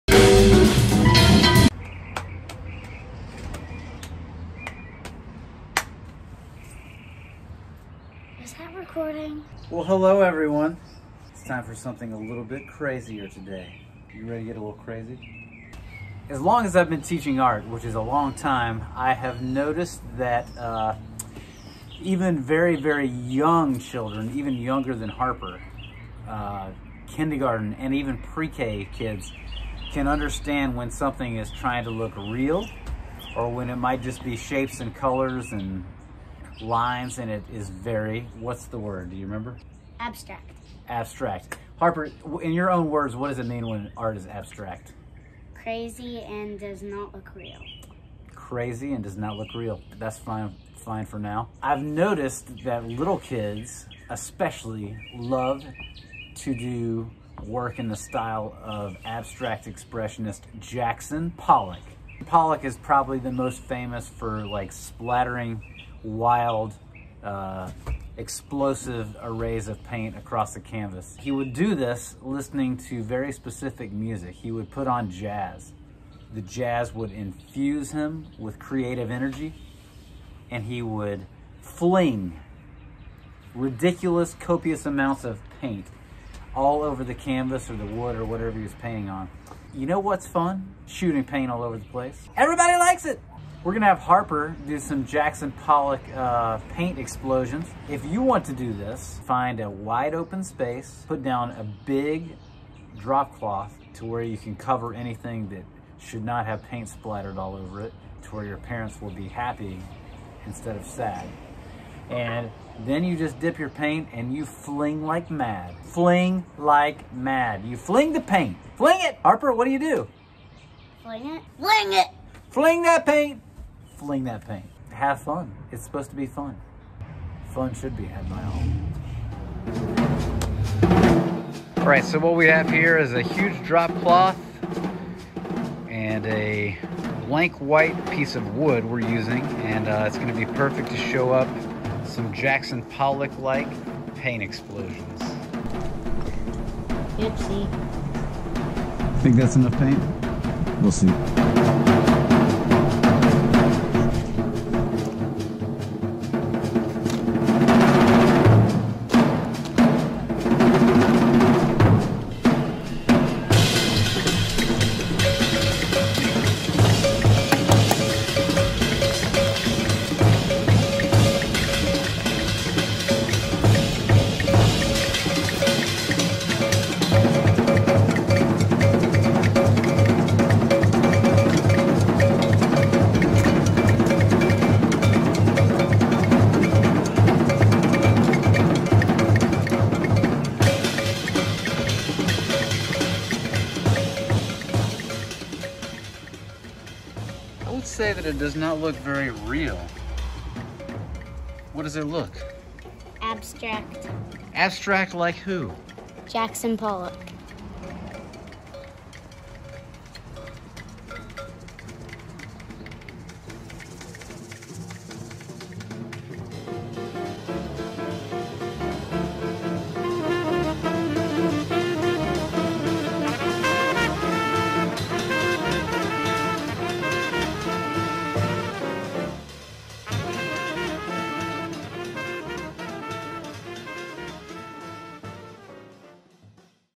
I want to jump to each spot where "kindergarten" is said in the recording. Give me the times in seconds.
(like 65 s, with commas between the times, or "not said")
27 s.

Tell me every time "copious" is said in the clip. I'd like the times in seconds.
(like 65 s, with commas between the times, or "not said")
84 s.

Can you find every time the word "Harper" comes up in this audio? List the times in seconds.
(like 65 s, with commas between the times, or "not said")
25 s, 41 s, 93 s, 119 s.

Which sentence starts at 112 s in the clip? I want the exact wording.
And then you just dip your paint and you fling like mad.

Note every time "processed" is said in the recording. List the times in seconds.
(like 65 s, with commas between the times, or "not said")
not said.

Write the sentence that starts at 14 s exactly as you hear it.
You ready to get a little crazy?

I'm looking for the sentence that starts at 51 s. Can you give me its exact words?
I've noticed that little kids especially love to do work in the style of abstract expressionist Jackson Pollock.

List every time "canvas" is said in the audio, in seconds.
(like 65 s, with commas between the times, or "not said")
70 s, 87 s.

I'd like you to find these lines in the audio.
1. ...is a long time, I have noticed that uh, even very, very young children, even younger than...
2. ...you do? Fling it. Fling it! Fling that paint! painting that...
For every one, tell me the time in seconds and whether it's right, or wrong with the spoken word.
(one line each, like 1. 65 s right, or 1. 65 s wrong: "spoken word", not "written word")
1. 17 s right
2. 119 s wrong: "fling", not "painting".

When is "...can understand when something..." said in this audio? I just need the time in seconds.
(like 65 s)
29 s.